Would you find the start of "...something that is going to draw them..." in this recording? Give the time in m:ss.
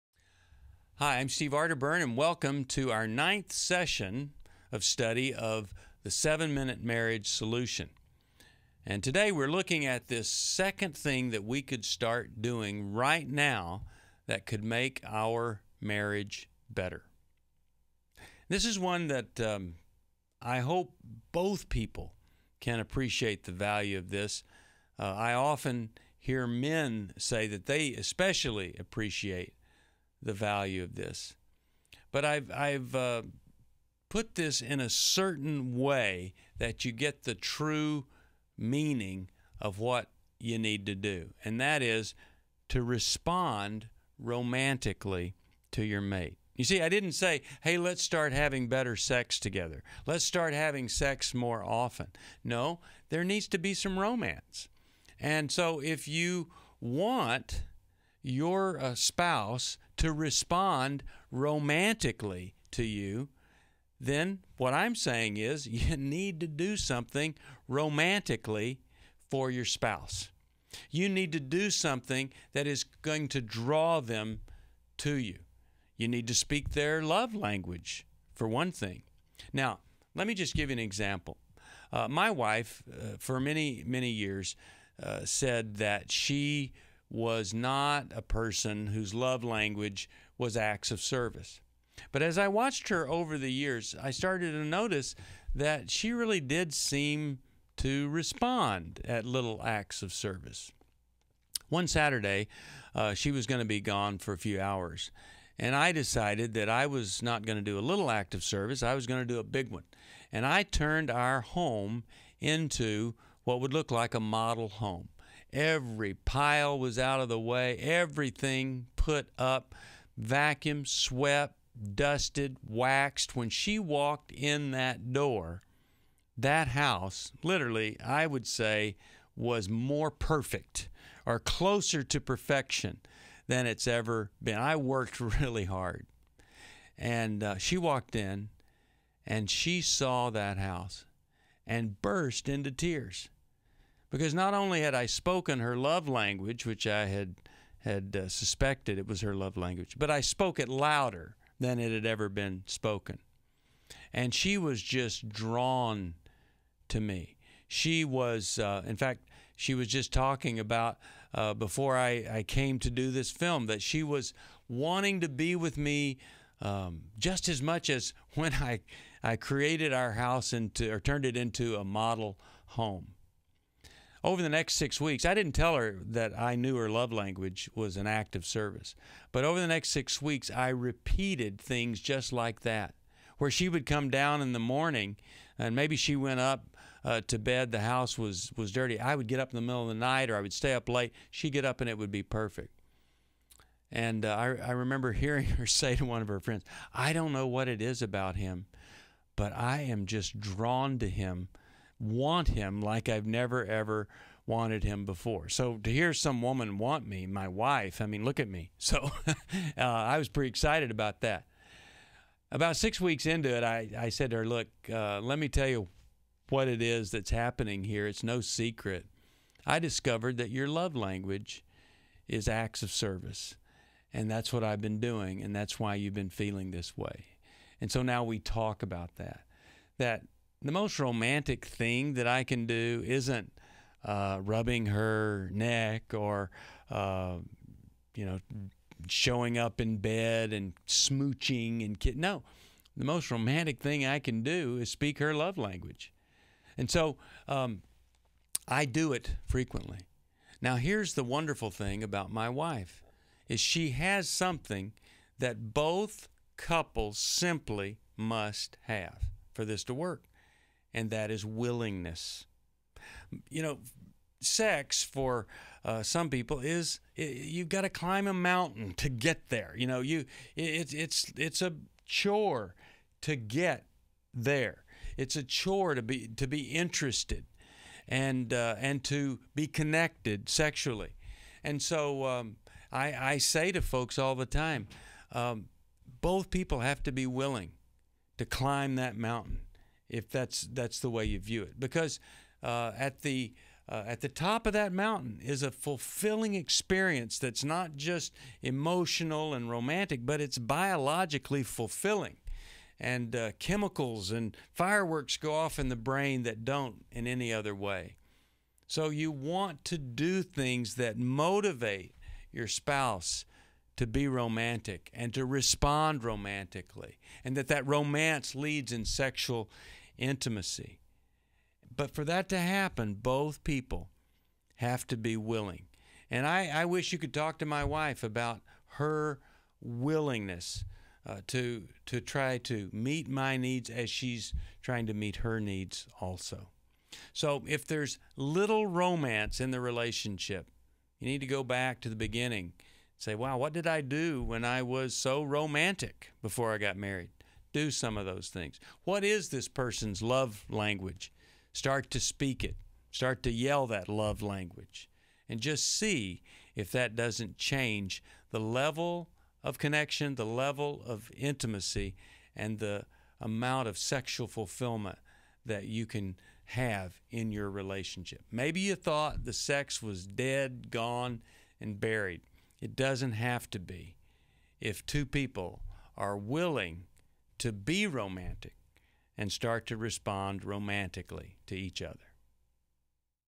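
1:11.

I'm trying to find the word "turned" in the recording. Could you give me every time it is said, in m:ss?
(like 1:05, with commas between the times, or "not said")
1:50, 2:50.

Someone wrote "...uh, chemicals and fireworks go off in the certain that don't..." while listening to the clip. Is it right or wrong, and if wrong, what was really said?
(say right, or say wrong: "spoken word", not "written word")
wrong: "brain", not "certain".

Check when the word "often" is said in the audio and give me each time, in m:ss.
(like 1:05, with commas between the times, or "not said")
0:25, 0:51.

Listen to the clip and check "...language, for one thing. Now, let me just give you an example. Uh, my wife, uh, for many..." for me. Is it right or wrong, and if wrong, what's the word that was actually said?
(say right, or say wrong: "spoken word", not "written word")
right.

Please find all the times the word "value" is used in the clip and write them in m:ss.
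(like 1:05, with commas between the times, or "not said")
0:23, 0:30.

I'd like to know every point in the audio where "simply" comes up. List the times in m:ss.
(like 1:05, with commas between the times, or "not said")
4:17.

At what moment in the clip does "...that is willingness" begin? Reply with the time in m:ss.
4:21.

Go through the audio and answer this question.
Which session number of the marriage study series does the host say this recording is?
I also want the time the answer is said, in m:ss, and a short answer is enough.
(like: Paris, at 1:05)
9th, at 0:03.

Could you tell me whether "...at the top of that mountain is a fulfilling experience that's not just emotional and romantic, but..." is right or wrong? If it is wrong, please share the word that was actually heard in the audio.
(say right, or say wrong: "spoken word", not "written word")
right.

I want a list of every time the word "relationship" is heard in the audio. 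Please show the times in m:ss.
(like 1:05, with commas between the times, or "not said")
5:39, 6:07.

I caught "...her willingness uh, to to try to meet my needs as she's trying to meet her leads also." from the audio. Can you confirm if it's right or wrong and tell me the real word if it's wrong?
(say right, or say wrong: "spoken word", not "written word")
wrong: "needs", not "leads".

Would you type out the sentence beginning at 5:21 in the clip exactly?
But for that to happen, both people have to be willing.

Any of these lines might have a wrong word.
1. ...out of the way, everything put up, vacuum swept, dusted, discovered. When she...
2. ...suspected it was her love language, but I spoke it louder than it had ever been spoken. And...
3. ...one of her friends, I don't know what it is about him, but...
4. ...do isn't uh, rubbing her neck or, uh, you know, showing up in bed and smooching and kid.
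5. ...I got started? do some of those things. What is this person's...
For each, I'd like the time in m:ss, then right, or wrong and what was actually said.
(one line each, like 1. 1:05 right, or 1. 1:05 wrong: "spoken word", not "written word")
1. 1:56 wrong: "waxed", not "discovered"
2. 2:28 right
3. 3:16 right
4. 3:52 right
5. 5:46 wrong: "married", not "started".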